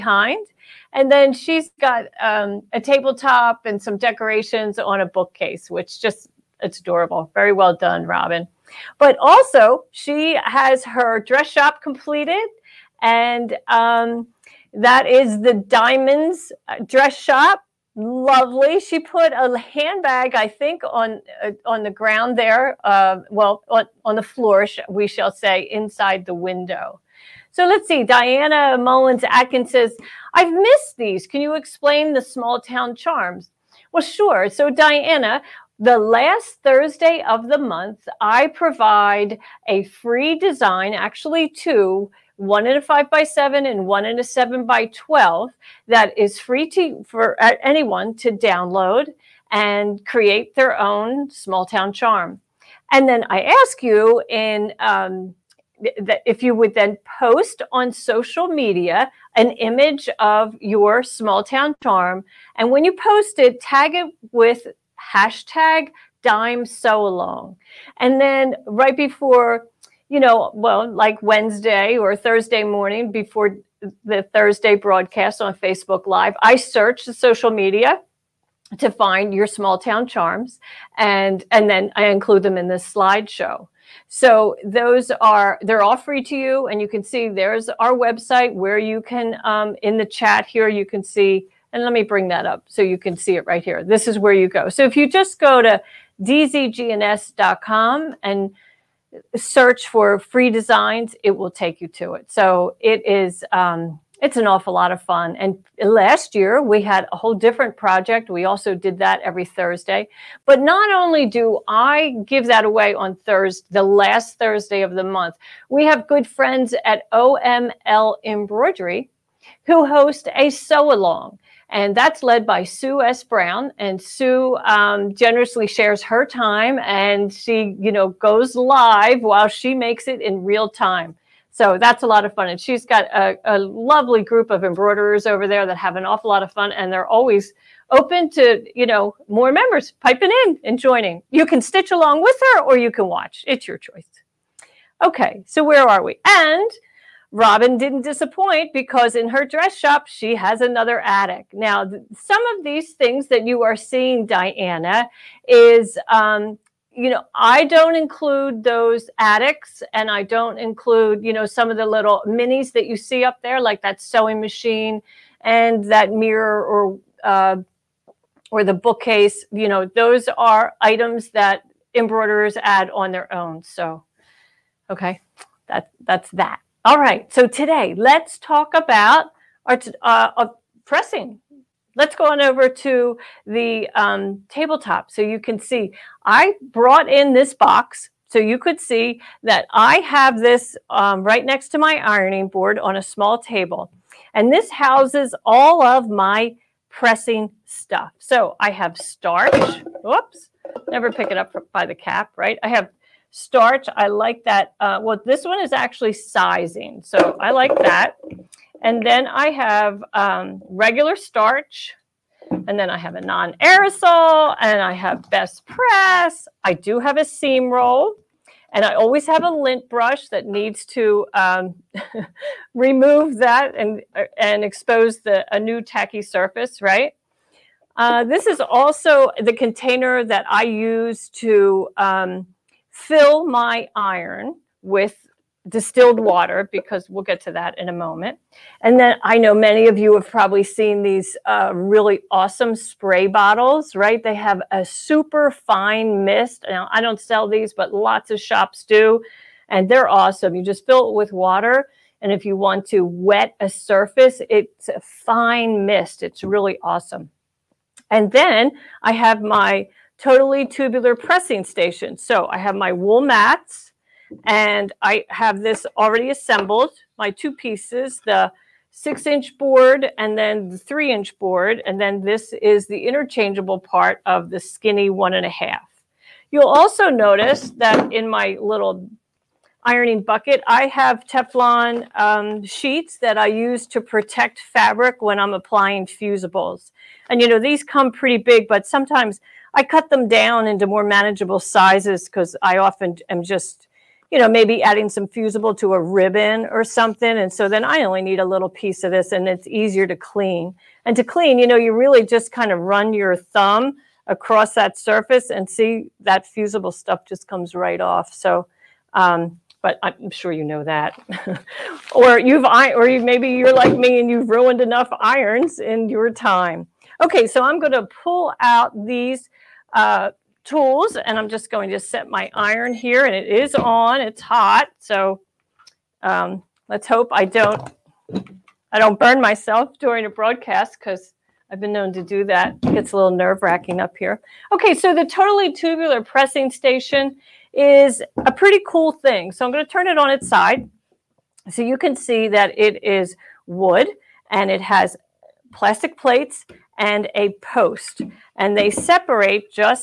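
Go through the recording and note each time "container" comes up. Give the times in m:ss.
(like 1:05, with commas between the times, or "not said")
3:49.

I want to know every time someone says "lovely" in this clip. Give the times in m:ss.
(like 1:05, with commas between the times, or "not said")
0:17, 2:13.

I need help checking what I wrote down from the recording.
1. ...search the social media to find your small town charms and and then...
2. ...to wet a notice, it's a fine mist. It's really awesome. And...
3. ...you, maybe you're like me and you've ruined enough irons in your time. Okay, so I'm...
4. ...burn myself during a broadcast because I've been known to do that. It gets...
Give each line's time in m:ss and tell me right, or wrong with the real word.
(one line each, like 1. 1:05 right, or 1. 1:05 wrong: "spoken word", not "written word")
1. 1:16 right
2. 4:12 wrong: "surface", not "notice"
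3. 5:13 right
4. 5:29 right.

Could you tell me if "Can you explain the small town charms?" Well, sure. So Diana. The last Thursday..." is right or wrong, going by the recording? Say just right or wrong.
right.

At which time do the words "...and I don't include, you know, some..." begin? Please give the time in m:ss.
2:39.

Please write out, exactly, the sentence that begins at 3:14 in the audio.
And this houses all of my pressing stuff.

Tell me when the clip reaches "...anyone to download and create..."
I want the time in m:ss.
0:47.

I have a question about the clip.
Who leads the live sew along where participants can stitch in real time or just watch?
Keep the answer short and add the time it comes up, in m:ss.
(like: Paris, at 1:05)
Sue S. Brown, at 2:02.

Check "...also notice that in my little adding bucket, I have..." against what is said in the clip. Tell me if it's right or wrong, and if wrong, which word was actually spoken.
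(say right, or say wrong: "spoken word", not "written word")
wrong: "ironing", not "adding".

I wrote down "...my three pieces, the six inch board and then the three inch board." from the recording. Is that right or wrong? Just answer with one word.
wrong.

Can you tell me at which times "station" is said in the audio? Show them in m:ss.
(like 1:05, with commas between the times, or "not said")
4:21, 5:36.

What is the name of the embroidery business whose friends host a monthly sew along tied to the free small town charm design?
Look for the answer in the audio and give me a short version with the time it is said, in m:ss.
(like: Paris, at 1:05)
OML Embroidery, at 1:57.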